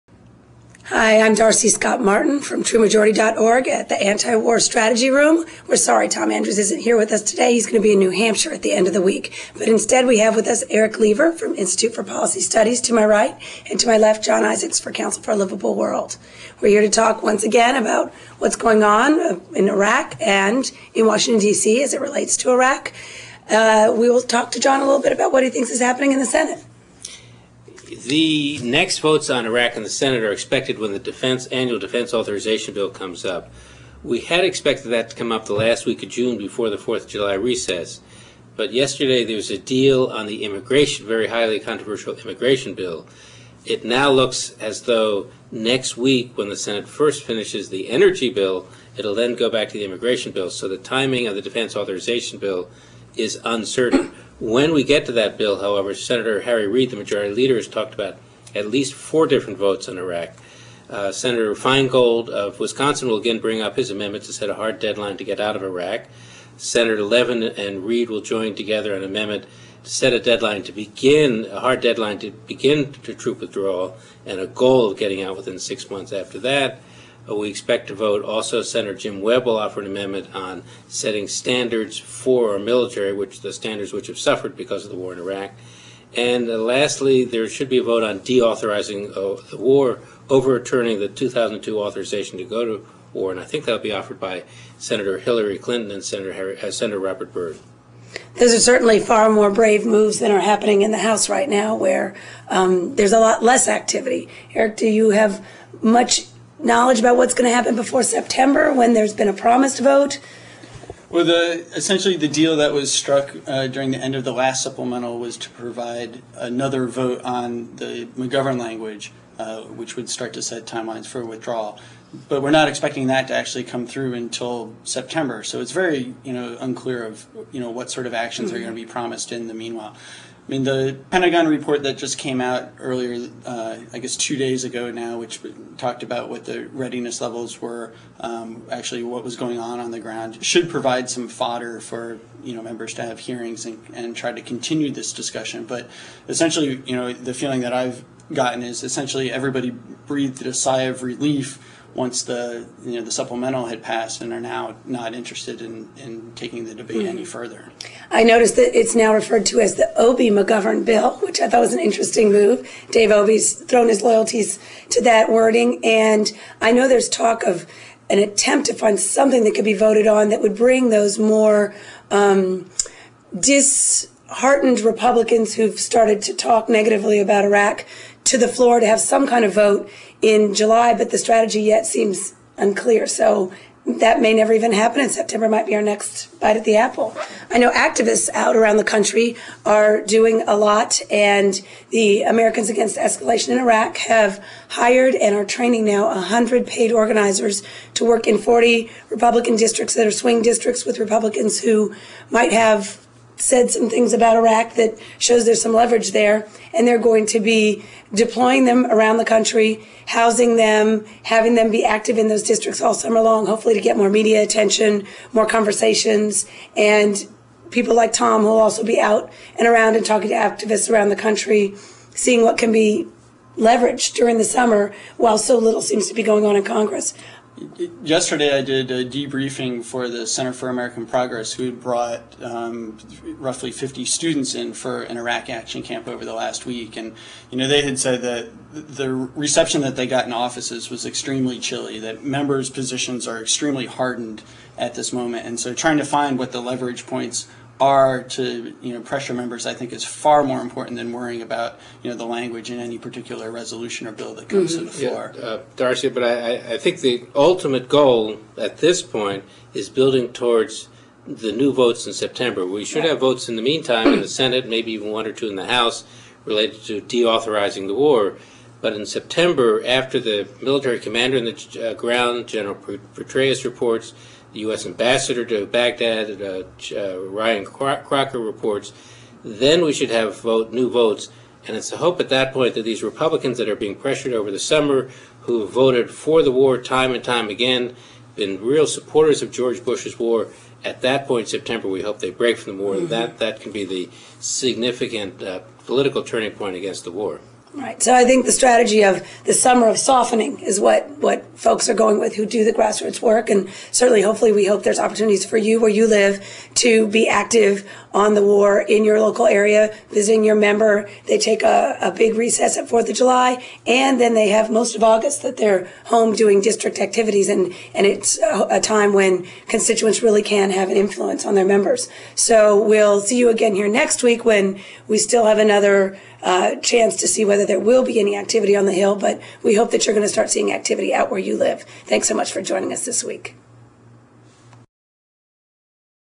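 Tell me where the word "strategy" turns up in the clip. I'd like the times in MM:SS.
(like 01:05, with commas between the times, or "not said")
00:04, 03:01, 04:58.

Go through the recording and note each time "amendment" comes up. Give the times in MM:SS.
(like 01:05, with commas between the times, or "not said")
01:03, 01:09, 01:19.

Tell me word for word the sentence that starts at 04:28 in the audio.
But in September, after the military commander in the uh, ground, General Petraeus reports, the U.S.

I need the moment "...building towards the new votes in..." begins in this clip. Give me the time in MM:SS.
04:19.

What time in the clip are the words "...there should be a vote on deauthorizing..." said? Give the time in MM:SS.
01:27.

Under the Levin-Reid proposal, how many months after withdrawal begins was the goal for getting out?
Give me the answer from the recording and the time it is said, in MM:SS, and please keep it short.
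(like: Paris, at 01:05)
6, at 01:15.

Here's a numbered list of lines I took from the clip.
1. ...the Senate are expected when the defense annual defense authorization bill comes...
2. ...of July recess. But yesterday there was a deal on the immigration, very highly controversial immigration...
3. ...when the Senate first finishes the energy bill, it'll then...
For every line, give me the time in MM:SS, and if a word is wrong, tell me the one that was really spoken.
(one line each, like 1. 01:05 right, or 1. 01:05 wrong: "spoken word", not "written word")
1. 00:29 right
2. 00:37 right
3. 00:46 right.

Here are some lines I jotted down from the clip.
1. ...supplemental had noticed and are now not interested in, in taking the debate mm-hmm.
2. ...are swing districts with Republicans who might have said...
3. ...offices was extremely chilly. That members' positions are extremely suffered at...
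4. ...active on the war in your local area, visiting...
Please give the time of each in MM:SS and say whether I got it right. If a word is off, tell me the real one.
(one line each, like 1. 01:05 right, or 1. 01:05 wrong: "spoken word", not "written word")
1. 02:33 wrong: "passed", not "noticed"
2. 03:20 right
3. 04:00 wrong: "hardened", not "suffered"
4. 05:07 right.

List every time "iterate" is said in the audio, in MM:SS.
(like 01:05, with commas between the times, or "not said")
not said.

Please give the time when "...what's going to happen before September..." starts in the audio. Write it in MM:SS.
01:47.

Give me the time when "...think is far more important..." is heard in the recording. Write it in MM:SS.
04:09.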